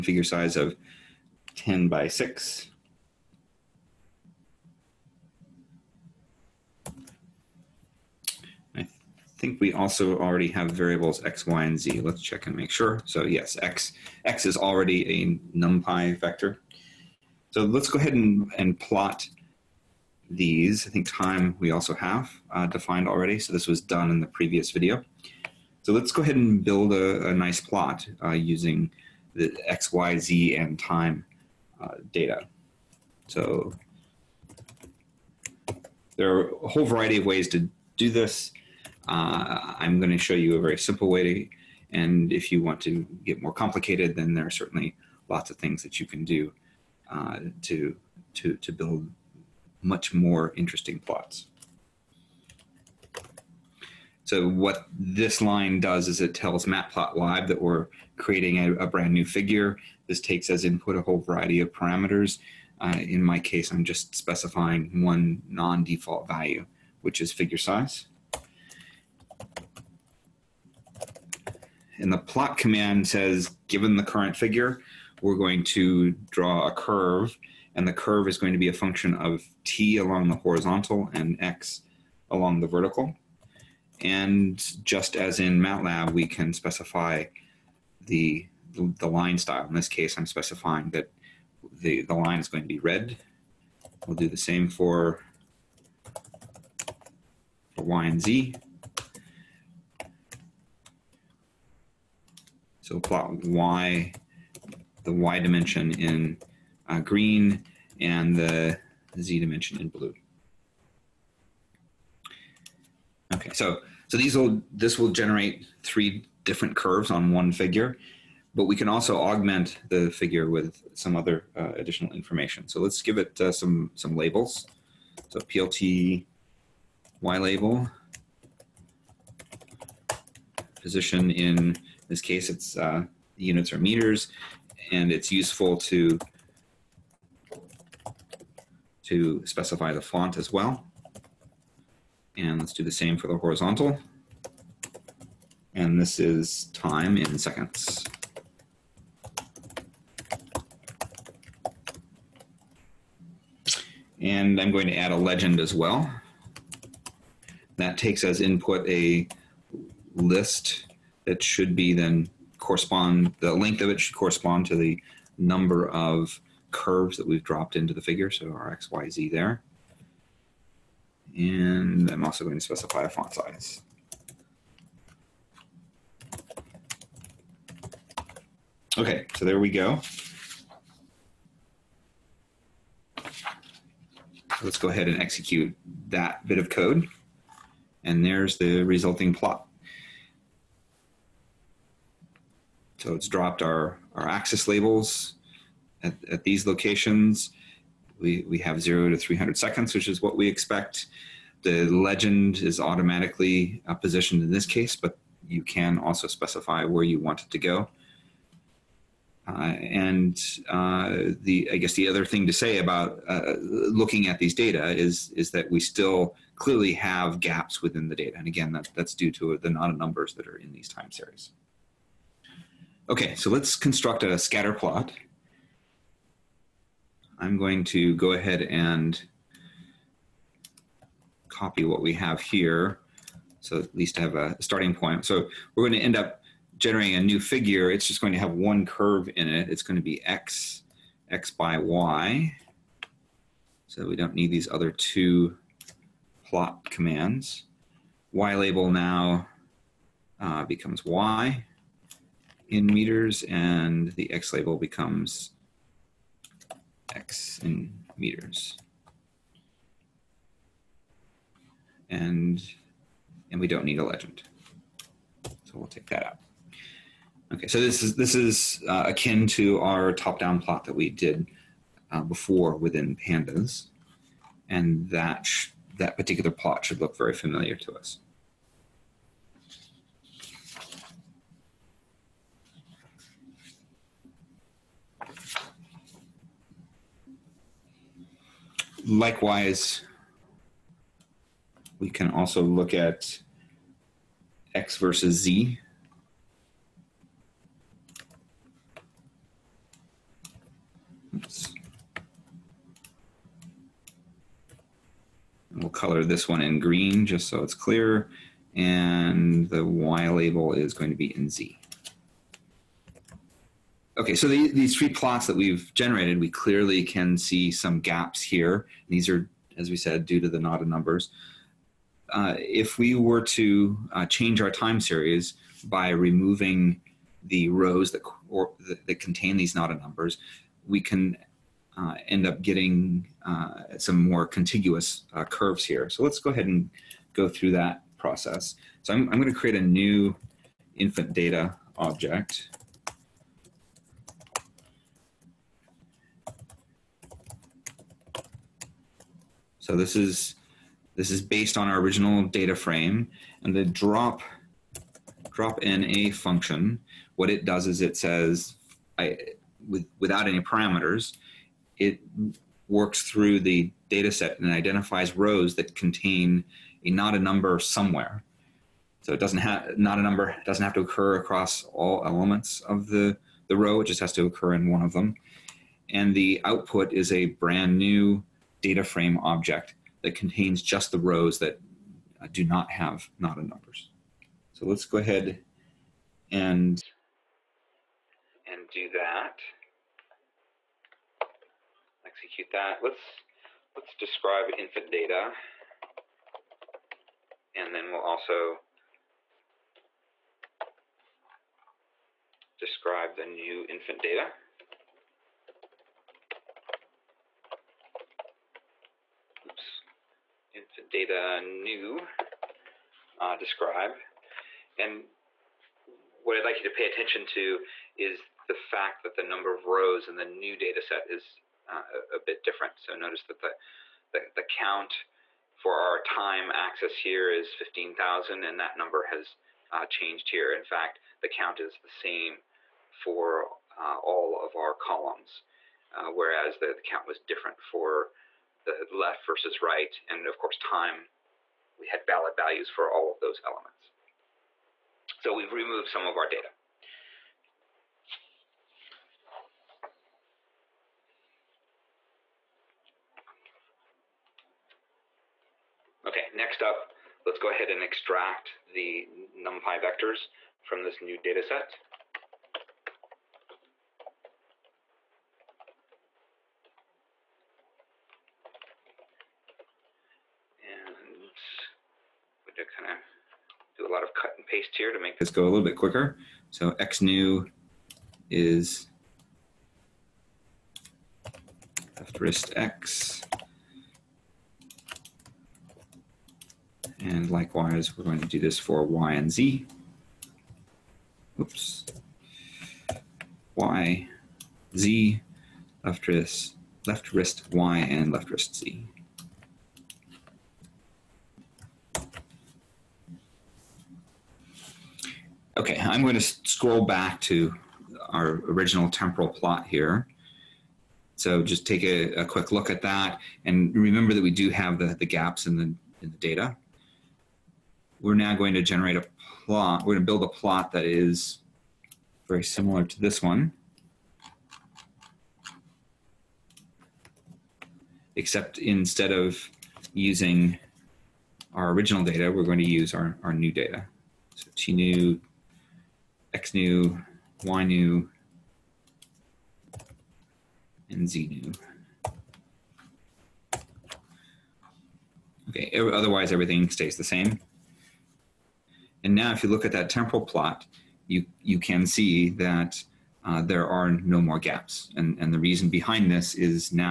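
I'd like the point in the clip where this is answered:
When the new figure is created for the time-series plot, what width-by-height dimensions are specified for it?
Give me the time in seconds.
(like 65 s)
1 s.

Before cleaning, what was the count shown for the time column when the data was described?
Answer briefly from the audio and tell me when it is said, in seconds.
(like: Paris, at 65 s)
15,000, at 427 s.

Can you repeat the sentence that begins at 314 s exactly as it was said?
Okay, so the, these three plots that we've generated, we clearly can see some gaps here.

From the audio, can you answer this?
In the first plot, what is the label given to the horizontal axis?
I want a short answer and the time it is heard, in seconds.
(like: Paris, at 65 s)
time in seconds, at 146 s.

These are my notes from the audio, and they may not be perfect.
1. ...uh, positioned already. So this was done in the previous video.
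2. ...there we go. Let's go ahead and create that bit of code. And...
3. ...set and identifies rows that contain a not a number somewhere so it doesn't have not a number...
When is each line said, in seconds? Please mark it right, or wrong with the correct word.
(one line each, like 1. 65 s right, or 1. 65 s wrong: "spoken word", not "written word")
1. 22 s wrong: "defined", not "positioned"
2. 179 s wrong: "execute", not "create"
3. 364 s right.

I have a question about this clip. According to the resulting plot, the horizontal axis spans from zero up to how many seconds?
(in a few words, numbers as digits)
300.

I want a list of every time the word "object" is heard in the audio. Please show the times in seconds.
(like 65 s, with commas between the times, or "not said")
341 s, 379 s.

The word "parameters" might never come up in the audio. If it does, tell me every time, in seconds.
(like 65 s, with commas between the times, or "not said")
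61 s, 360 s.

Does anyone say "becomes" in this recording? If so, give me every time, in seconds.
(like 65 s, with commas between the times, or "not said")
250 s, 254 s.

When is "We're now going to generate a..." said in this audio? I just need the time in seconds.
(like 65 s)
518 s.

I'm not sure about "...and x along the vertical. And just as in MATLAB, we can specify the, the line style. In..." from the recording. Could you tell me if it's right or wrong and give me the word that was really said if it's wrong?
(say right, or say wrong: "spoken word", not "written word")
right.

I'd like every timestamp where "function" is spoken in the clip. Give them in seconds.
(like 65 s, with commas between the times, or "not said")
78 s, 356 s.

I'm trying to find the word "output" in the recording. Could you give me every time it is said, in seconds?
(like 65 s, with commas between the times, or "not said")
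376 s.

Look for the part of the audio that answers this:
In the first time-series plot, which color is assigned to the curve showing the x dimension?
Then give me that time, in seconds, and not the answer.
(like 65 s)
92 s.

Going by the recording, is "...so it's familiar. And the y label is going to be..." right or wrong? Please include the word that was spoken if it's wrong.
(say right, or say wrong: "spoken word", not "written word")
wrong: "clear", not "familiar".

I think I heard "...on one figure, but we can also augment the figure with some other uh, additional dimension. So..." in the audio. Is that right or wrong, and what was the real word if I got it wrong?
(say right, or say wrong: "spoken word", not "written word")
wrong: "information", not "dimension".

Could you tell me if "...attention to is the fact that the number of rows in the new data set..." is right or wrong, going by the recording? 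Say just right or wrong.
right.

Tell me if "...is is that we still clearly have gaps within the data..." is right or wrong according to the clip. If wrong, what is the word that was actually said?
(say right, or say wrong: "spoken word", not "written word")
right.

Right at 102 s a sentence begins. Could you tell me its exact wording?
So plot Y, the Y dimension in uh, green and the Z dimension in blue.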